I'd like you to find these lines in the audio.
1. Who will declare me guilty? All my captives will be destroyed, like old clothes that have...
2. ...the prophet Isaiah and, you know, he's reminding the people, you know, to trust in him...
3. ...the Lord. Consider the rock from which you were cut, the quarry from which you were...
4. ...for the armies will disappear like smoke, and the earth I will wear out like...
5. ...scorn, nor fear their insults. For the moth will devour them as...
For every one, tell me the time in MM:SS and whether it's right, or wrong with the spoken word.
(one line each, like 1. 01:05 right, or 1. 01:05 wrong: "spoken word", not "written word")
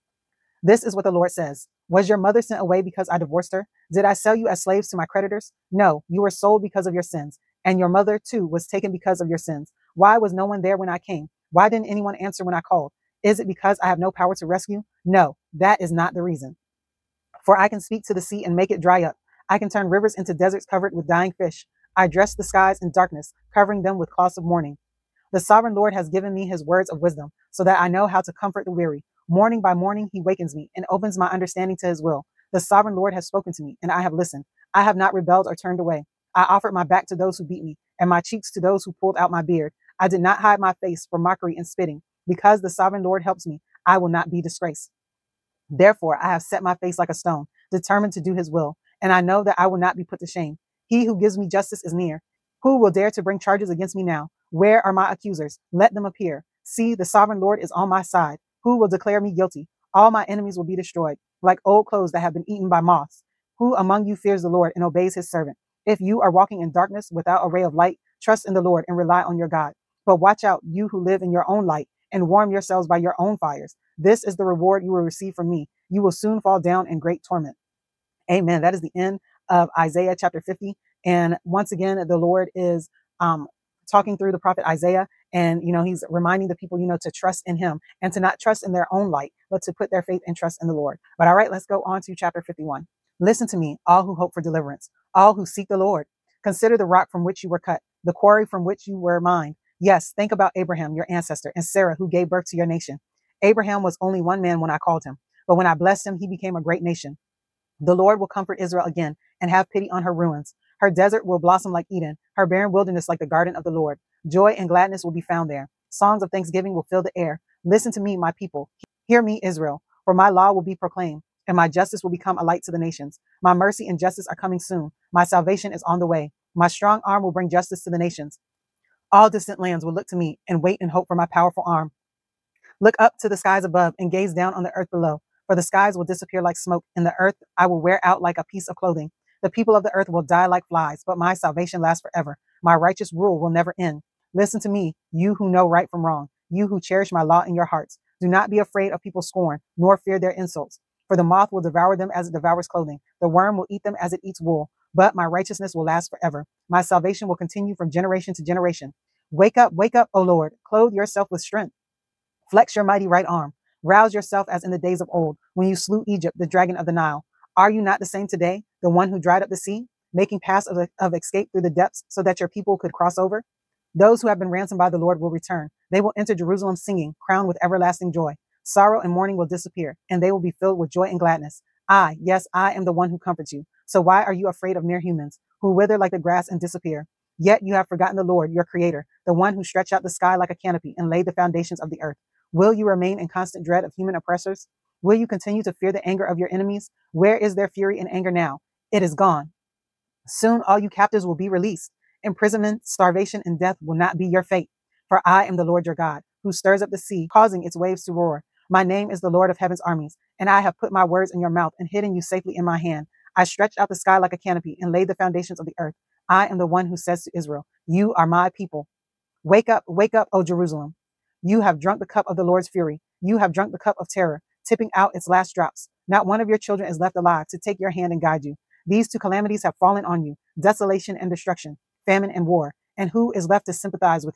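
1. 00:58 wrong: "enemies", not "captives"
2. 01:24 right
3. 01:35 right
4. 02:15 wrong: "skies", not "armies"
5. 02:29 right.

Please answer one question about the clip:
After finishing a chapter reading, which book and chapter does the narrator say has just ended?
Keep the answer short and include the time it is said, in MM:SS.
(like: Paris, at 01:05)
Isaiah chapter 50, at 01:19.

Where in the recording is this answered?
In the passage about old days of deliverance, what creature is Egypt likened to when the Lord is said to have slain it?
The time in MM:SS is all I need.
02:46.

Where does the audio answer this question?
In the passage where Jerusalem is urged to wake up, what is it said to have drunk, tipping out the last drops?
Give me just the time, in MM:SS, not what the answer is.
03:43.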